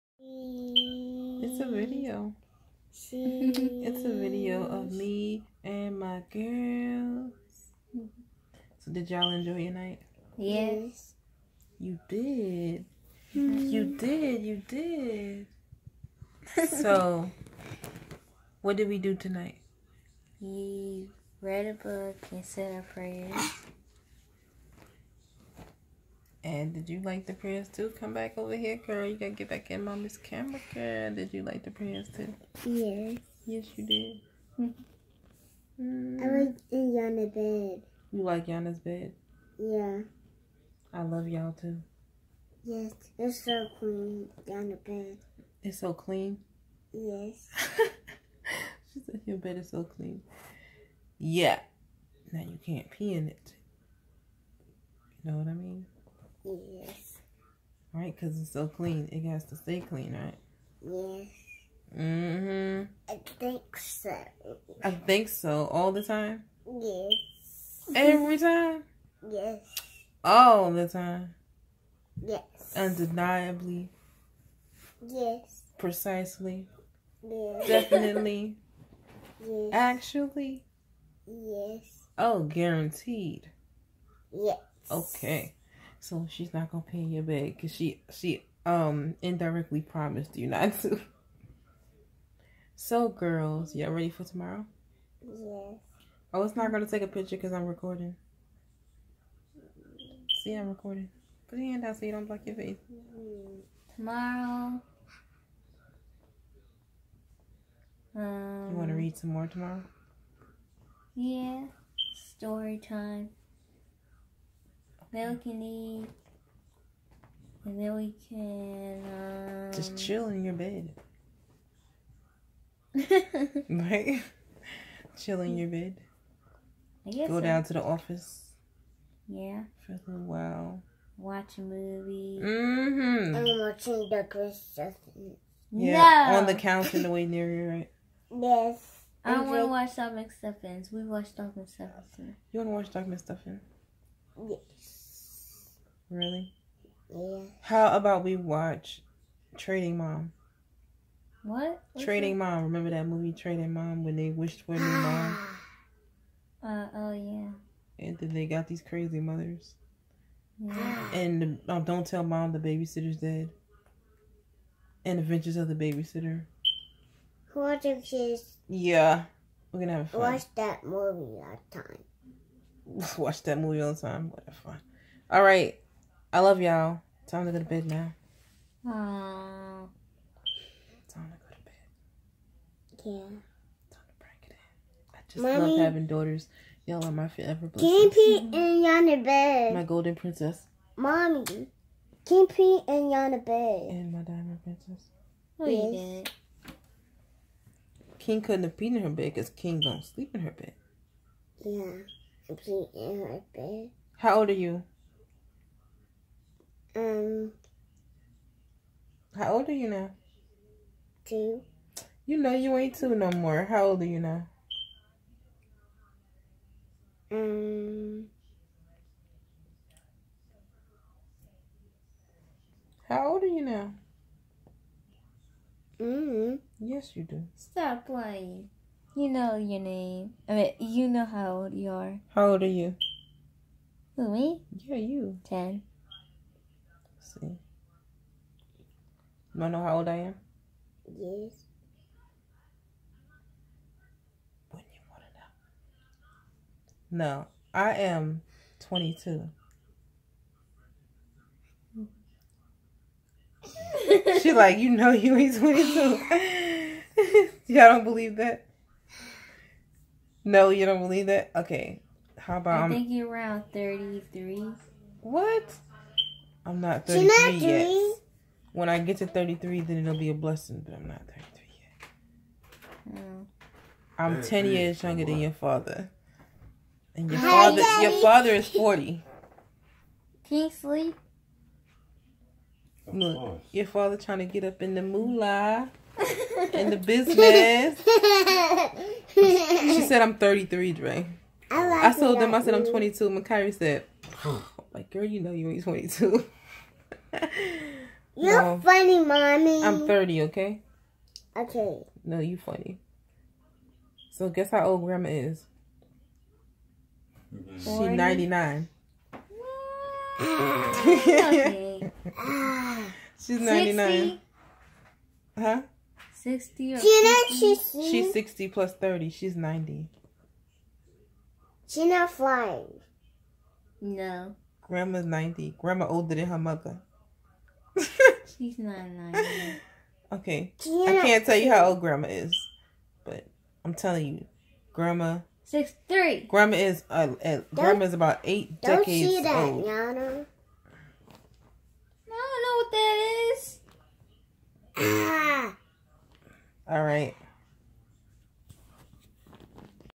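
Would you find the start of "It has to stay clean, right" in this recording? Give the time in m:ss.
0:59.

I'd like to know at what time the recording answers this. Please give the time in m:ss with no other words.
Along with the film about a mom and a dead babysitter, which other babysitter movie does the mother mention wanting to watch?
2:45.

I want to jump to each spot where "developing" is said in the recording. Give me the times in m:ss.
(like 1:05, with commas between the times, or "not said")
not said.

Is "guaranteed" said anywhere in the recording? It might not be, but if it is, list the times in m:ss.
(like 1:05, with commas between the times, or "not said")
1:22.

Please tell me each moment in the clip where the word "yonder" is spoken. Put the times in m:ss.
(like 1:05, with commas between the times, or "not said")
3:08, 3:13.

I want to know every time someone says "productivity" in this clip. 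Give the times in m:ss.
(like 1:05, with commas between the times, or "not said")
not said.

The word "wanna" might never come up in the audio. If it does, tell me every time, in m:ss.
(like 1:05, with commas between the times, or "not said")
3:59, 4:05.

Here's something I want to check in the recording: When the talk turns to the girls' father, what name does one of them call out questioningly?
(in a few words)
Kingsley.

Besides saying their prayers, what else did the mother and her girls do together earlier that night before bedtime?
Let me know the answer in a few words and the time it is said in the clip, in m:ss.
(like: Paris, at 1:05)
Read a book, at 0:21.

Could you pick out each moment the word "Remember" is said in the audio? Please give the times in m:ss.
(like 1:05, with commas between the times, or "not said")
2:32.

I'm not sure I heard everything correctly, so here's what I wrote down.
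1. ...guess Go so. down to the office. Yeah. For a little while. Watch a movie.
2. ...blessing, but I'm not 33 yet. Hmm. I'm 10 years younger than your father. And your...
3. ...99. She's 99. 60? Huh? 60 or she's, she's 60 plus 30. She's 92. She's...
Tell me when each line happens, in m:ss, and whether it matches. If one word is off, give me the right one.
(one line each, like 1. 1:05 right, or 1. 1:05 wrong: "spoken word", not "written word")
1. 2:07 right
2. 4:30 right
3. 5:13 wrong: "90", not "92".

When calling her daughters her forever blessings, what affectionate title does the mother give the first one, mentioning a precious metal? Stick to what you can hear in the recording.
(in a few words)
Golden princess.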